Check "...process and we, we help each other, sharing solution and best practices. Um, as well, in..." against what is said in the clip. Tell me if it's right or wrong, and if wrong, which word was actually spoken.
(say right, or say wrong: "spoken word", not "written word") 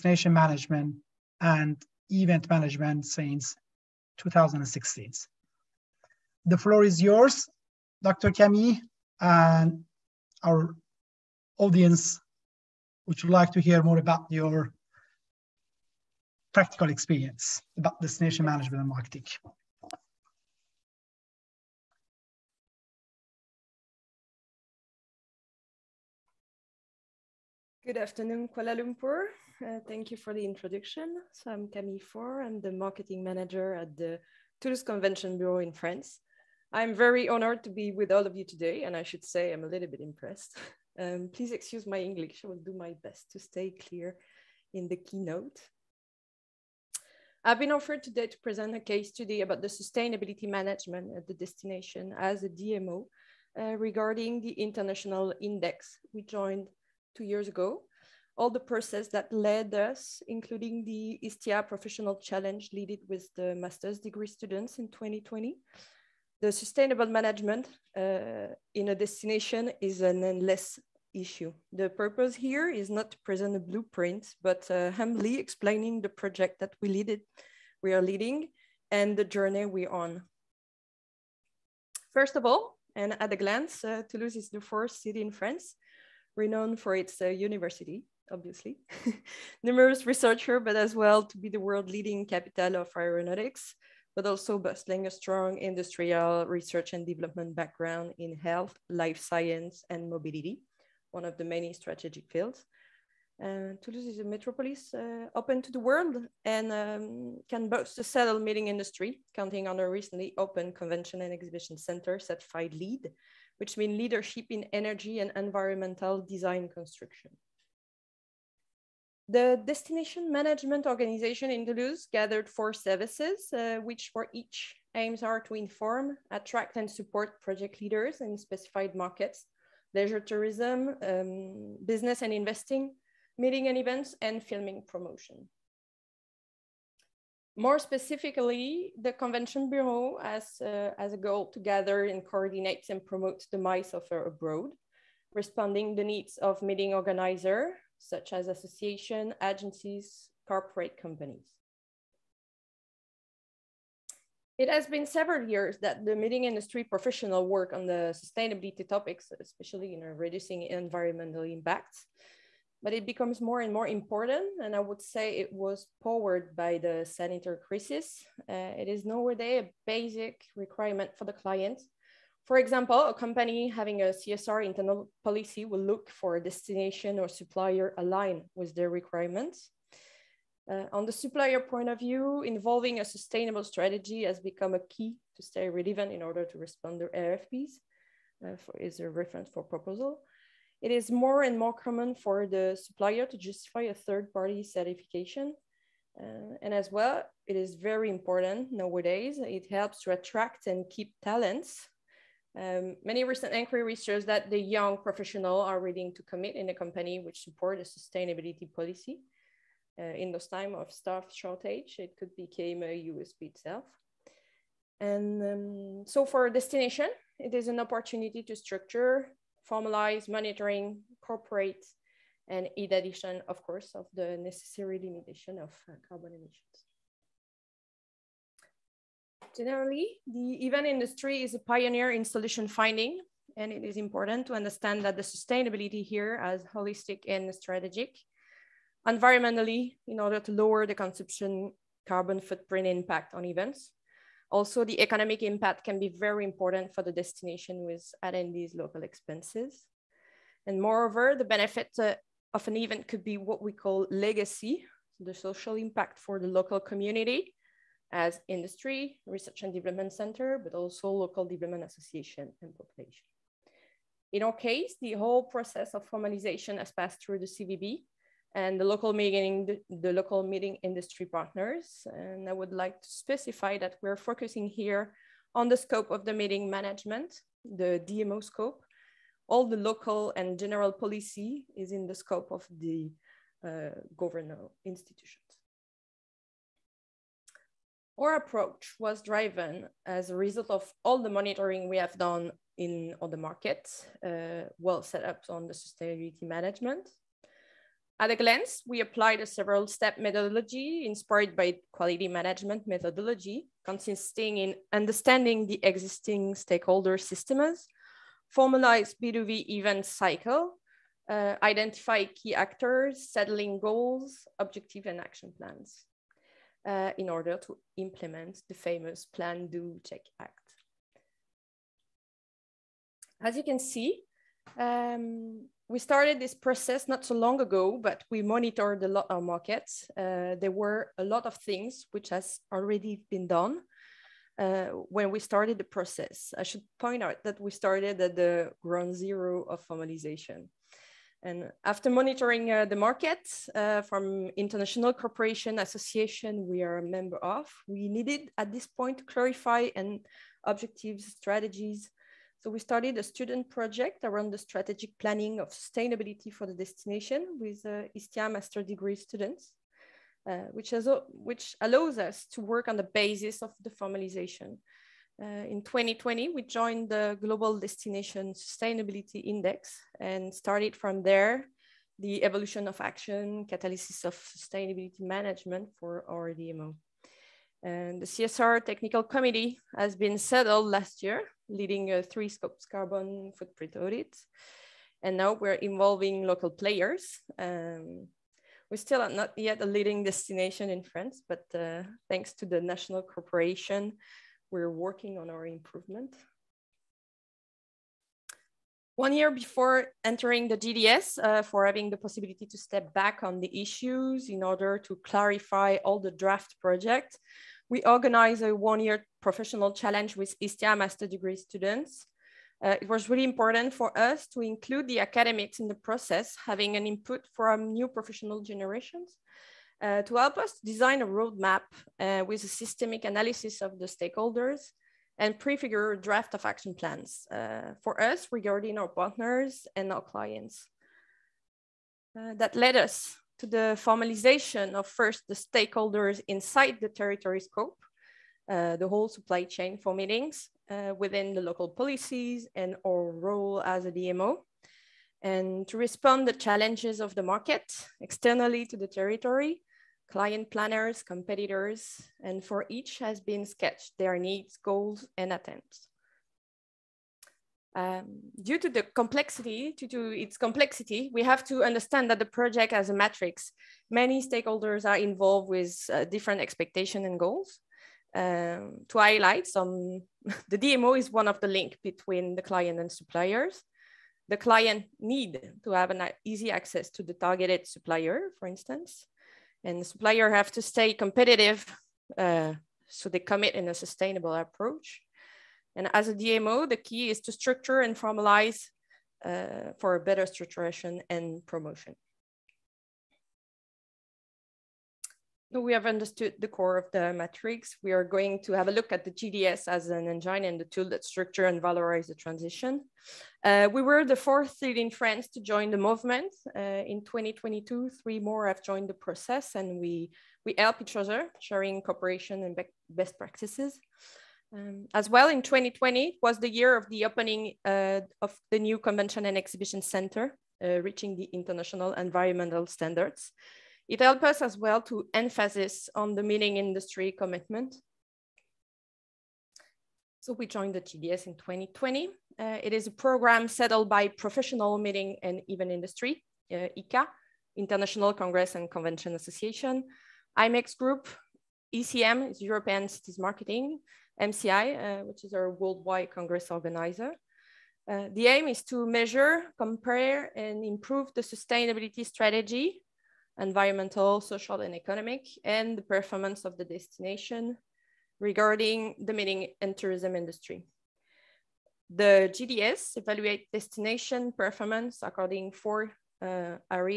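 wrong: "cooperation", not "solution".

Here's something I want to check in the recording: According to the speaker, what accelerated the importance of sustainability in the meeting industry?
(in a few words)
The sanitary crisis.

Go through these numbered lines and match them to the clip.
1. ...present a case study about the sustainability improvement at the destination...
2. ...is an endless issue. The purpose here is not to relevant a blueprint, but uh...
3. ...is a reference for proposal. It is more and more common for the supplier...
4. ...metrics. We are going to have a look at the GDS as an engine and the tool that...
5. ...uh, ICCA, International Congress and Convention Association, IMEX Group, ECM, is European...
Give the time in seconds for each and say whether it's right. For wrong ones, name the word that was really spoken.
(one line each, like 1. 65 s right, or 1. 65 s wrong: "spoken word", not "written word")
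1. 48 s wrong: "management", not "improvement"
2. 69 s wrong: "present", not "relevant"
3. 188 s right
4. 497 s right
5. 536 s right.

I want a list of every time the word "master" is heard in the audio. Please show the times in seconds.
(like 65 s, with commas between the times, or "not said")
63 s, 358 s, 410 s.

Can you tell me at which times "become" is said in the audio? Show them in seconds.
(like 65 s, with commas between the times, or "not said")
163 s, 184 s, 212 s.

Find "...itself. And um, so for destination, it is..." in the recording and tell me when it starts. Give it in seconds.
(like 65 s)
213 s.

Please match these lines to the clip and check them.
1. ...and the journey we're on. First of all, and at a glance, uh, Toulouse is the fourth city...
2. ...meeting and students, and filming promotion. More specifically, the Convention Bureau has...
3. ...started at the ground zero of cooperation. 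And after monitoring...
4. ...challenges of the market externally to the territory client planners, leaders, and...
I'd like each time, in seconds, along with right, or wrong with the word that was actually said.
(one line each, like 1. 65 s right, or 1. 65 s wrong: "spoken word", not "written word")
1. 78 s right
2. 133 s wrong: "events", not "students"
3. 337 s wrong: "formalization", not "cooperation"
4. 446 s wrong: "competitors", not "leaders".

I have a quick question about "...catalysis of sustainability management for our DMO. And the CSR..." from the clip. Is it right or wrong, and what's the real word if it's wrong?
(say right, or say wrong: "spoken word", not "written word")
right.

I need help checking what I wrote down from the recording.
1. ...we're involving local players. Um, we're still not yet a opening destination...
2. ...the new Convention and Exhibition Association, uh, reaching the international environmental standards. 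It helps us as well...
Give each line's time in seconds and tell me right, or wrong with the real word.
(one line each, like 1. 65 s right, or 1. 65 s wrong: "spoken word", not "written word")
1. 385 s wrong: "leading", not "opening"
2. 518 s wrong: "Center", not "Association".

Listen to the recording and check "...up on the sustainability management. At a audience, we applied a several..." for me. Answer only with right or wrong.
wrong.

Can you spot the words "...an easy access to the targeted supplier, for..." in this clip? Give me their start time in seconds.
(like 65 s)
476 s.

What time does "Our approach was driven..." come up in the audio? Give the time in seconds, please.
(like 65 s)
288 s.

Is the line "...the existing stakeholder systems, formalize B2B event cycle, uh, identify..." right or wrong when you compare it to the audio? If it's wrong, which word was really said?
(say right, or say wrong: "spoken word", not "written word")
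right.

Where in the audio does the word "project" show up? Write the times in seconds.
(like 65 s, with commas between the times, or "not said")
76 s, 127 s, 353 s, 406 s, 462 s.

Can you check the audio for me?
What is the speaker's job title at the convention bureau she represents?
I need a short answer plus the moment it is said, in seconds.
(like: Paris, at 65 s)
Marketing manager, at 32 s.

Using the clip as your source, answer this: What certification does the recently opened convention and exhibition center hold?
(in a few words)
LEED.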